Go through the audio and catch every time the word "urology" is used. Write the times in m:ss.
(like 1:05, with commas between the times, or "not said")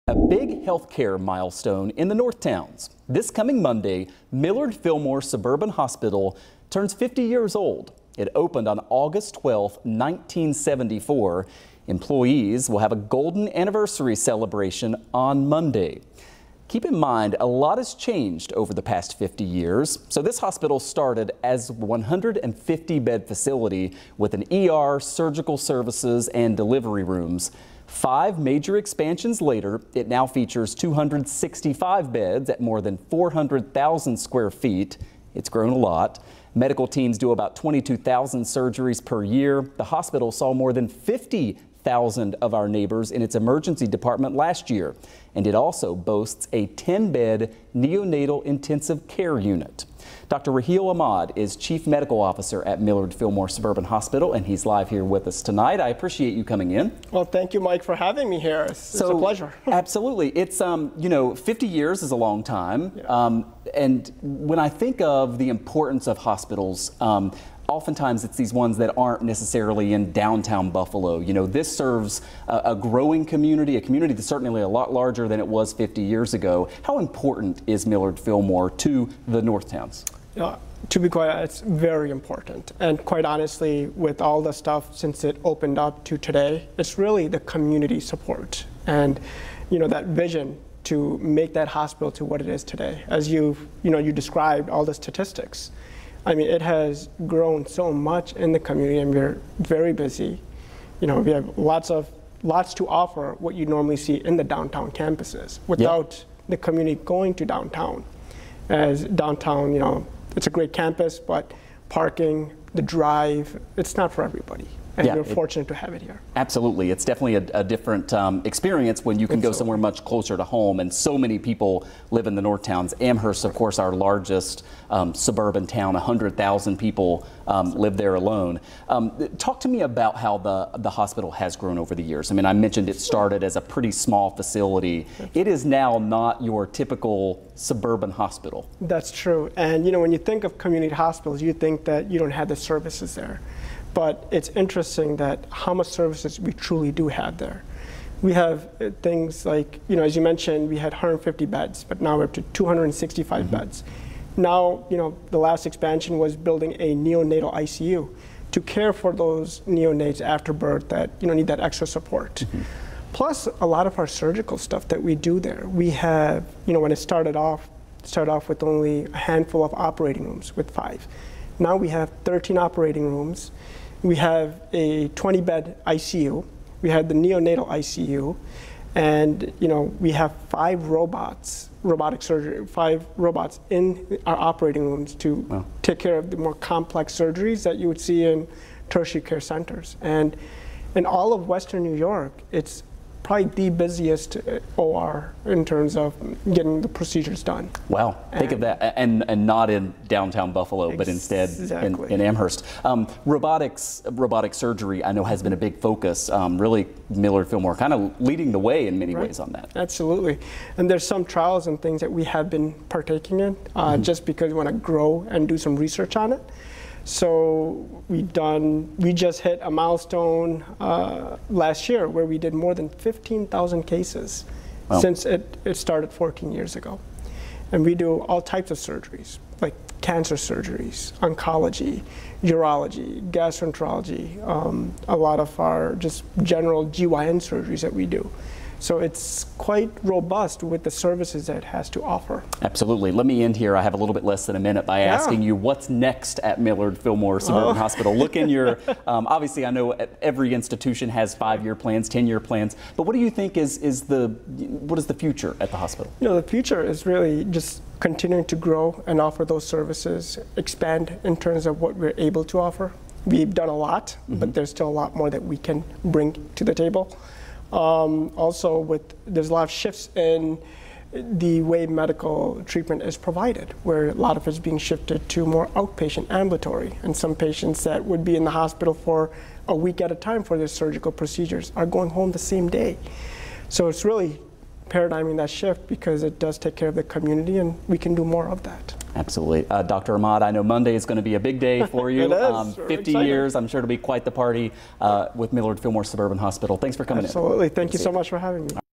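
3:52.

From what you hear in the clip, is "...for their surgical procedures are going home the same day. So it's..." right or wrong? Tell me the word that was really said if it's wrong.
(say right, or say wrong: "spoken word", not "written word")
right.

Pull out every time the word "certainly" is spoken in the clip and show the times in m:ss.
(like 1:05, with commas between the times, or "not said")
1:14.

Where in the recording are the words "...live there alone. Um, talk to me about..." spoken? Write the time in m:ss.
2:07.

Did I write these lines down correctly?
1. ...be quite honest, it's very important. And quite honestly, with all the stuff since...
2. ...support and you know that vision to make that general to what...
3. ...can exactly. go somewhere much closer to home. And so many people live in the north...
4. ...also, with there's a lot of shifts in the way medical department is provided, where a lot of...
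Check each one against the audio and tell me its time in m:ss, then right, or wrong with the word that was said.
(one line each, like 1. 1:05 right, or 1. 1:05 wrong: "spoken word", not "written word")
1. 1:20 right
2. 1:27 wrong: "hospital", not "general"
3. 1:59 wrong: "absolutely", not "exactly"
4. 4:28 wrong: "treatment", not "department".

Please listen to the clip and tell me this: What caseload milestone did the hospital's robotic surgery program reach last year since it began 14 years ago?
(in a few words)
more than 15,000 cases.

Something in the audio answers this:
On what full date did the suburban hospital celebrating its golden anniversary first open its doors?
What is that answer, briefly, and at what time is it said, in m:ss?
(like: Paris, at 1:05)
August 12, 1974, at 0:08.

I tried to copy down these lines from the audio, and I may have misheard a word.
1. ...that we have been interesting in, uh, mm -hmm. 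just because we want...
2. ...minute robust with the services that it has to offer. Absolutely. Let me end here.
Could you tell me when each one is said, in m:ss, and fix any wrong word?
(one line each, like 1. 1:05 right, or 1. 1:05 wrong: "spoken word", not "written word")
1. 3:32 wrong: "partaking", not "interesting"
2. 3:59 wrong: "quite", not "minute".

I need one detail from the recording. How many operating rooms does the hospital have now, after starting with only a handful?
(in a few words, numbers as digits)
13.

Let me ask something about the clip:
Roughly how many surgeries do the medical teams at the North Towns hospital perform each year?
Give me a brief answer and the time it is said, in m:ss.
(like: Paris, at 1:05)
22,000, at 0:37.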